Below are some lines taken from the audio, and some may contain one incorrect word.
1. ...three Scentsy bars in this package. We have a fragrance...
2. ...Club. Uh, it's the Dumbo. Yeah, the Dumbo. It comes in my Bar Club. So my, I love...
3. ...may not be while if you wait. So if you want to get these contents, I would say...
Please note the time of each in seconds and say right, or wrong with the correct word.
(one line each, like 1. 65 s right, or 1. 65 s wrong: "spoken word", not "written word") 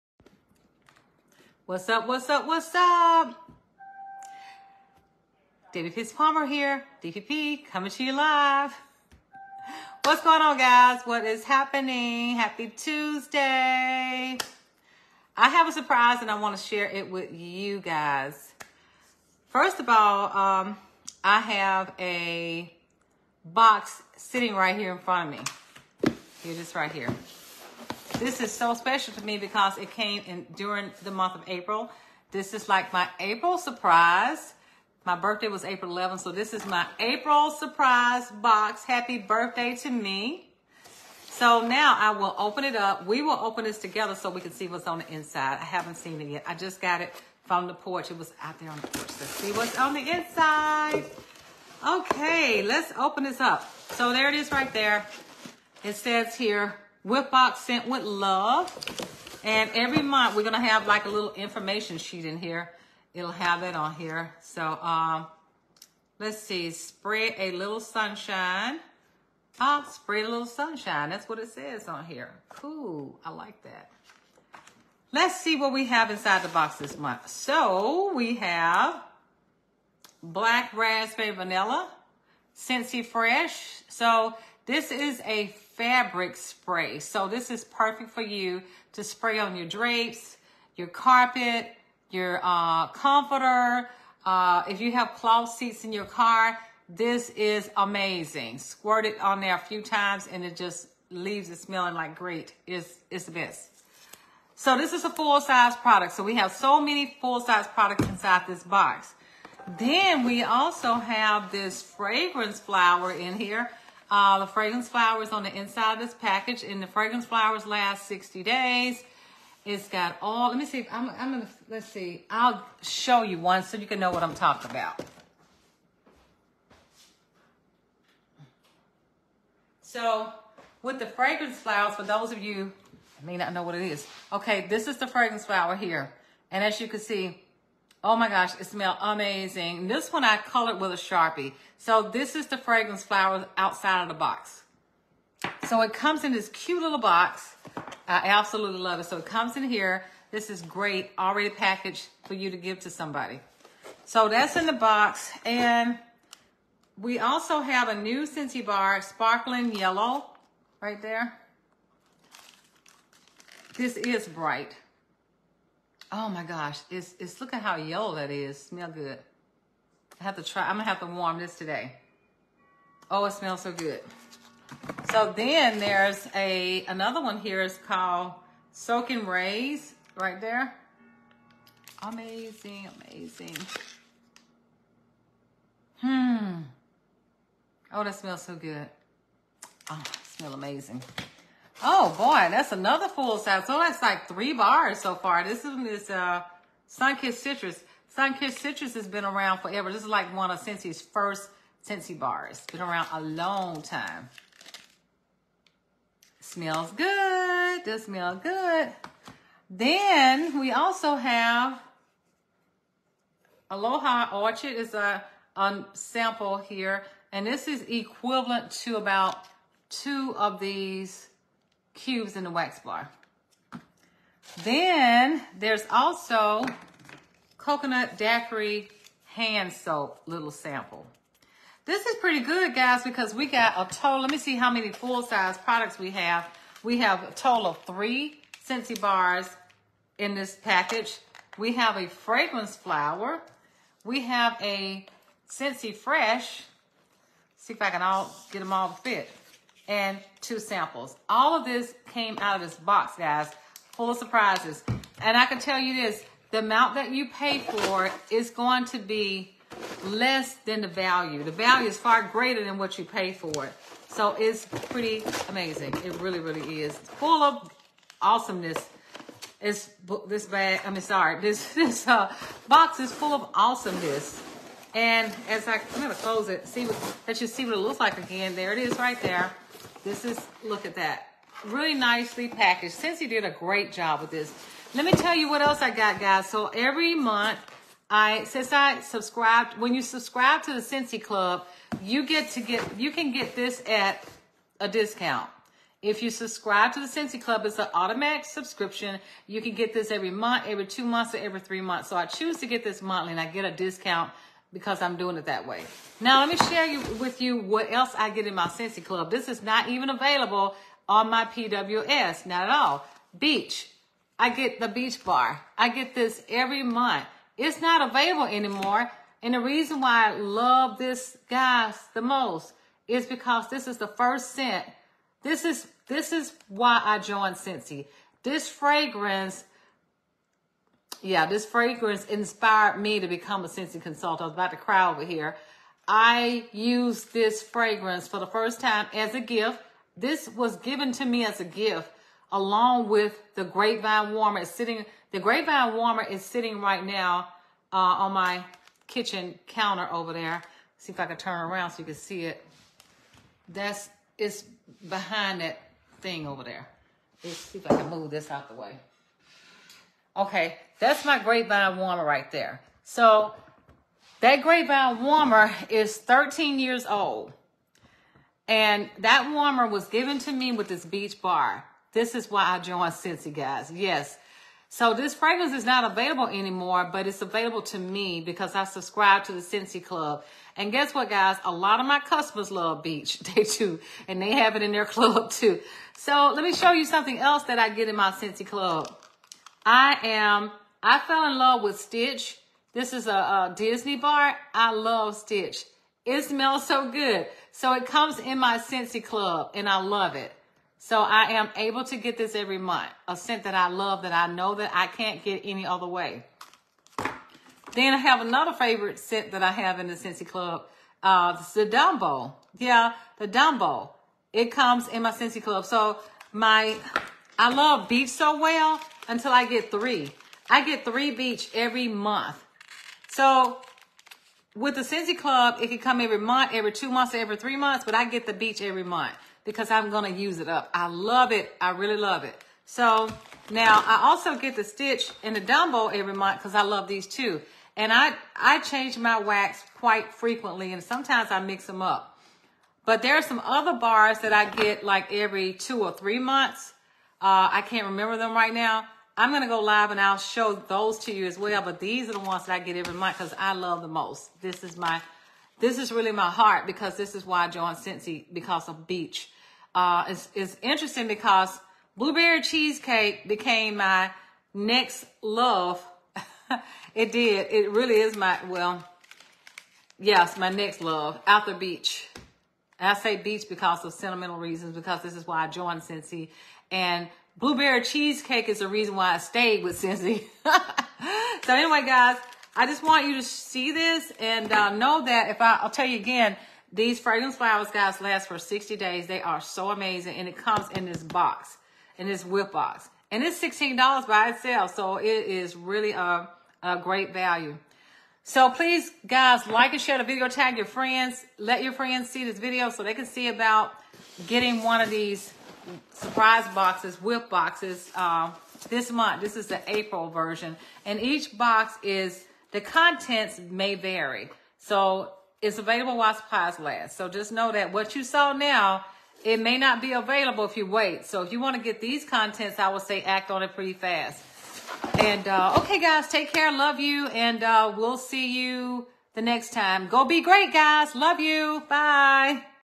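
1. 237 s right
2. 410 s wrong: "Scentsy", not "Bar"
3. 519 s wrong: "available", not "while".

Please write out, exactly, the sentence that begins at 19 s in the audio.
First of all, um, I have a box sitting right here in front of me.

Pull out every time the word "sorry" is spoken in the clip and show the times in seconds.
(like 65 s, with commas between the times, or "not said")
271 s.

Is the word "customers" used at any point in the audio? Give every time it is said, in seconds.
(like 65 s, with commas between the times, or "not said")
382 s.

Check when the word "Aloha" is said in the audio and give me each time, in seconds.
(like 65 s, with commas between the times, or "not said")
213 s.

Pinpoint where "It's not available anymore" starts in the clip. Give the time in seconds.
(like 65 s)
317 s.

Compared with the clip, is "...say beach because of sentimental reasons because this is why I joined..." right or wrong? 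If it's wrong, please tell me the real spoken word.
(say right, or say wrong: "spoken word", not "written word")
right.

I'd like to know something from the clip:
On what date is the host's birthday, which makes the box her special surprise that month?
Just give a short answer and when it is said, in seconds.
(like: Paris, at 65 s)
April 11th, at 35 s.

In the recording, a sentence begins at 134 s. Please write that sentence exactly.
Okay, this is the fragrance flower here.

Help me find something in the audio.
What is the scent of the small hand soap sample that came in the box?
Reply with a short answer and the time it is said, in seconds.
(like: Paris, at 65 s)
Coconut daiquiri, at 227 s.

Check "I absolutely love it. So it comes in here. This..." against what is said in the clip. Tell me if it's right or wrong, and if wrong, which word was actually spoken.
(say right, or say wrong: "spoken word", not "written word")
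right.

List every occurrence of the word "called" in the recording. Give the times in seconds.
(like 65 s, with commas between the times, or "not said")
177 s.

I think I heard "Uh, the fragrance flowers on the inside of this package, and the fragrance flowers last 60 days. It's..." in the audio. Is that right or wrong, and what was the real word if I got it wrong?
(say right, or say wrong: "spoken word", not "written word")
right.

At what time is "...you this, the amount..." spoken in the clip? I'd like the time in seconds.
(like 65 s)
255 s.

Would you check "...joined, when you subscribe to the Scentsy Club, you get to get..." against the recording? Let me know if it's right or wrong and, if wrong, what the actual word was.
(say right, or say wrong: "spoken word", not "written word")
wrong: "subscribed", not "joined".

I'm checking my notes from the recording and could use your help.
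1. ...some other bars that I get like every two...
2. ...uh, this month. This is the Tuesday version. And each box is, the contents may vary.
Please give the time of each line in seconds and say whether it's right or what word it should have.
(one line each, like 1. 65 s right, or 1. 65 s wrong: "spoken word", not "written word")
1. 443 s right
2. 508 s wrong: "April", not "Tuesday".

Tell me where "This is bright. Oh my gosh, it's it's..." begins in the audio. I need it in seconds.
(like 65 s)
163 s.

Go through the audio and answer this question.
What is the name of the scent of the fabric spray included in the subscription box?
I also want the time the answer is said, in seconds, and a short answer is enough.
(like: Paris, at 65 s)
Black raspberry vanilla, at 80 s.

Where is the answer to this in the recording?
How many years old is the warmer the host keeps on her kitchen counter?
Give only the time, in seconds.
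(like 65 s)
366 s.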